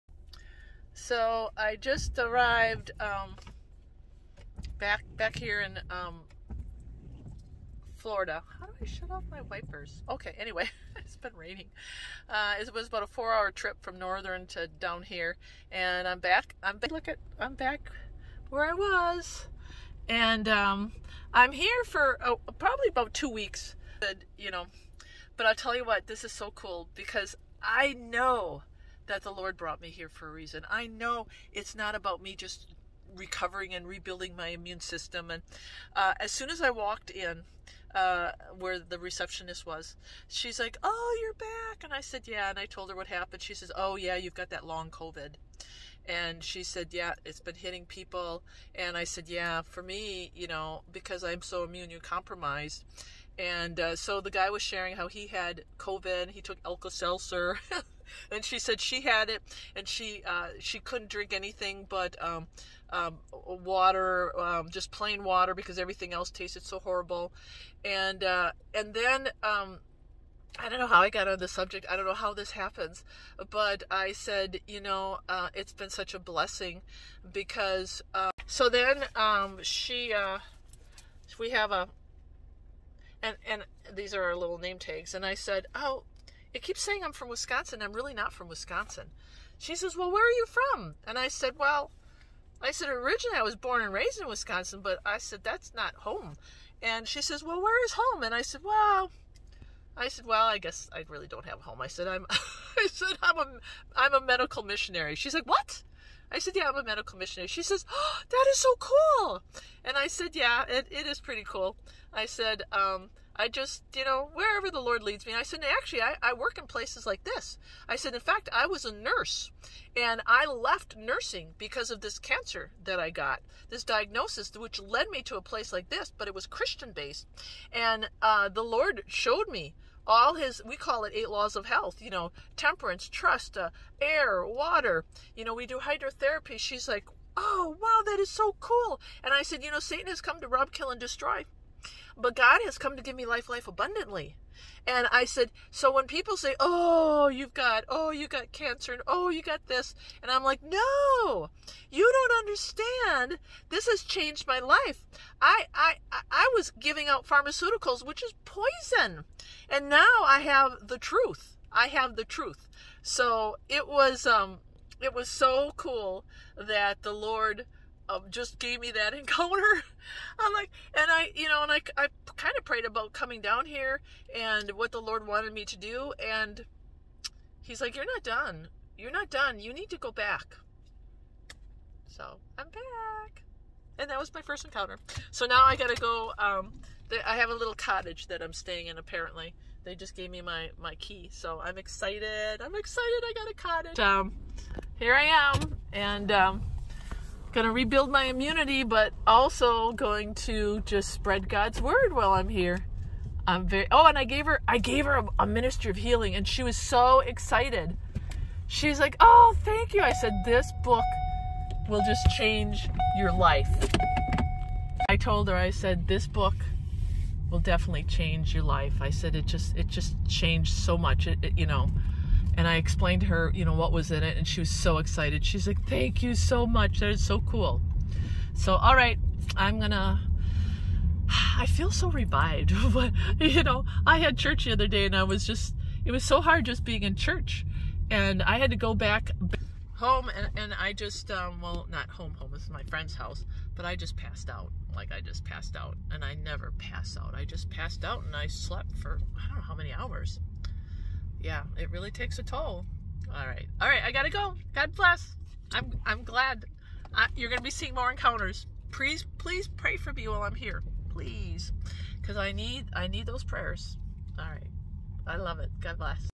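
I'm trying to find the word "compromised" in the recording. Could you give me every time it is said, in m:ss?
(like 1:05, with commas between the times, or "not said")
0:52.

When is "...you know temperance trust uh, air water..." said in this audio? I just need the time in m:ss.
2:12.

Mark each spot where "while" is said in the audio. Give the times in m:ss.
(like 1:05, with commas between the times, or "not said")
3:22, 4:20.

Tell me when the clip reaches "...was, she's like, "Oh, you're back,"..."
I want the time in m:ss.
0:39.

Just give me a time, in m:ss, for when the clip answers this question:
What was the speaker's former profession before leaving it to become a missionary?
1:58.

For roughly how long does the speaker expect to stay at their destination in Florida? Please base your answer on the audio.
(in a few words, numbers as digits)
about 2 weeks.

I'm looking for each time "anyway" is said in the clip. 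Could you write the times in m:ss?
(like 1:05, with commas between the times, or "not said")
0:10.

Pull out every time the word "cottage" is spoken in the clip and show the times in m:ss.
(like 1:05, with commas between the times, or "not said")
3:07, 3:13.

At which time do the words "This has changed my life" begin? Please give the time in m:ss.
2:33.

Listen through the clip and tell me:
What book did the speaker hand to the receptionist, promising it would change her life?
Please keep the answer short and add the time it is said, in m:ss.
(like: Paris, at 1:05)
Ministry of Healing, at 3:25.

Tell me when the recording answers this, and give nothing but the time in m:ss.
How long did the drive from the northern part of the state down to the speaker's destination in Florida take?
0:13.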